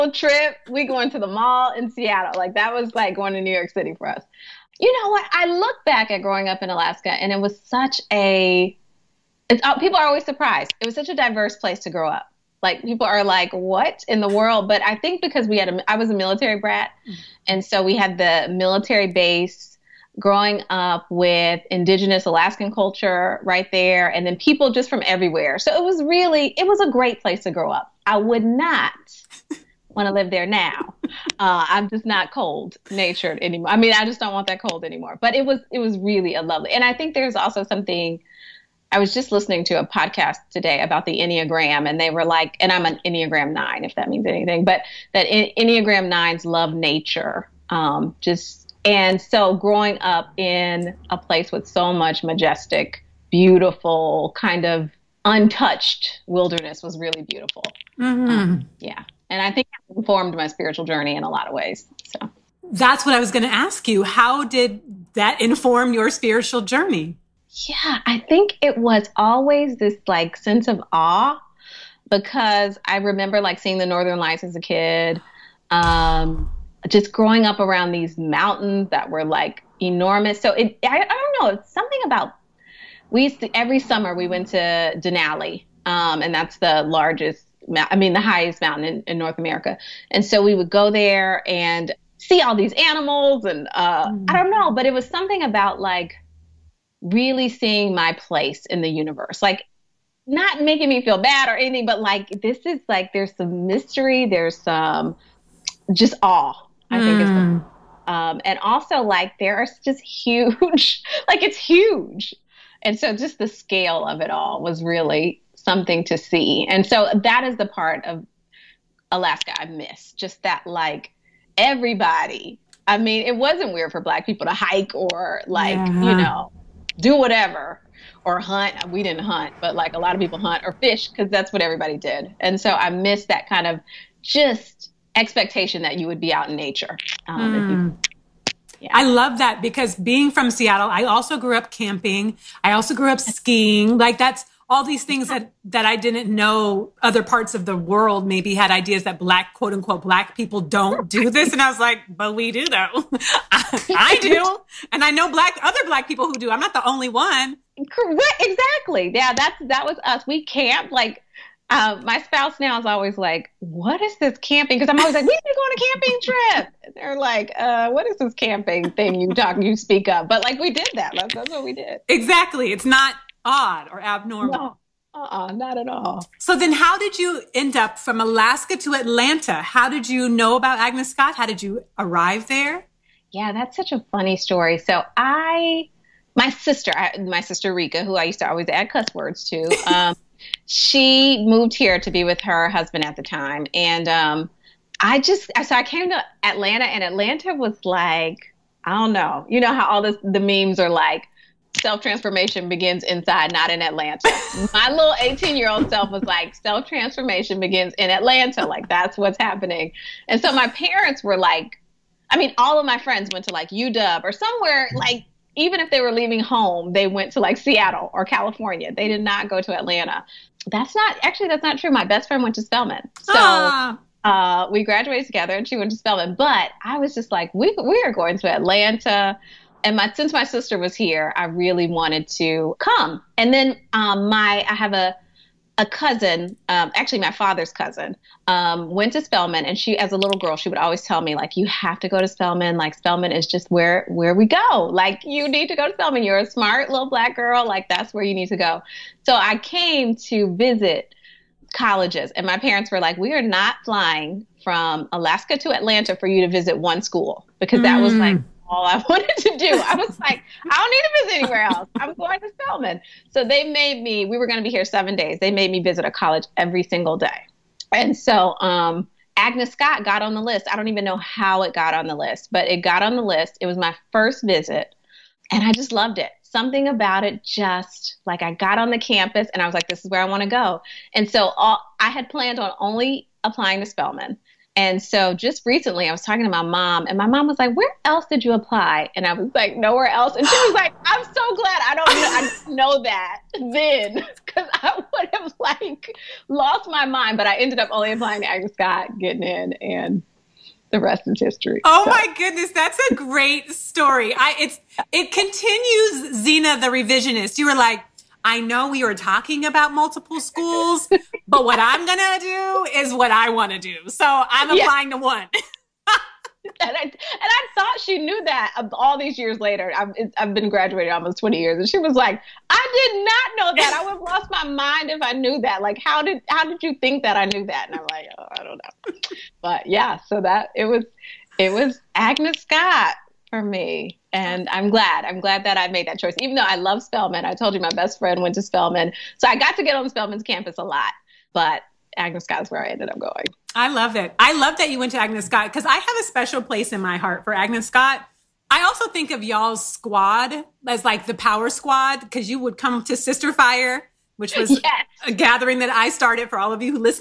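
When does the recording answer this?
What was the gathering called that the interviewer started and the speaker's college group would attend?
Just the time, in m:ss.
5:53.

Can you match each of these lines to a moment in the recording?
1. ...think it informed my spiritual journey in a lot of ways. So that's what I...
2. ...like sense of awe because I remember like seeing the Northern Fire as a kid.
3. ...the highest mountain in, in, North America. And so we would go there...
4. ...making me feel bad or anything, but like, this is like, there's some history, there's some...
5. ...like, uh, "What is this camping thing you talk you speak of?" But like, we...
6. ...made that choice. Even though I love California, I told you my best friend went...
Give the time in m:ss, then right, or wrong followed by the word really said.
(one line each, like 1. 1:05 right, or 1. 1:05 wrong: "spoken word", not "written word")
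1. 0:59 right
2. 1:10 wrong: "Lights", not "Fire"
3. 1:28 right
4. 1:40 wrong: "mystery", not "history"
5. 2:47 right
6. 5:35 wrong: "Spelman", not "California".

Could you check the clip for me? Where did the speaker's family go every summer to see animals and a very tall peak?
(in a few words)
Denali.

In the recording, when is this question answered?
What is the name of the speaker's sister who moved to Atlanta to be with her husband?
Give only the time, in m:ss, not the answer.
3:07.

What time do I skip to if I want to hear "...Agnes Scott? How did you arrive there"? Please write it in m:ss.
3:00.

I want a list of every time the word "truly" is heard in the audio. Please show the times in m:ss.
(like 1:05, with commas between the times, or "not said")
not said.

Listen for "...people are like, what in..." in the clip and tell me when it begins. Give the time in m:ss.
0:12.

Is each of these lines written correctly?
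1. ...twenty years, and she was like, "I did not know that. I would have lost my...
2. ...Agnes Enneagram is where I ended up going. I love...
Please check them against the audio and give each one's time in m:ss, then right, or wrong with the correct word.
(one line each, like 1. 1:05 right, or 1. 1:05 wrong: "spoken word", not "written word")
1. 5:21 right
2. 5:42 wrong: "Scott", not "Enneagram".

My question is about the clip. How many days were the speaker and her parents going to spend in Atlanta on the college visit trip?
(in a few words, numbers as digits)
7.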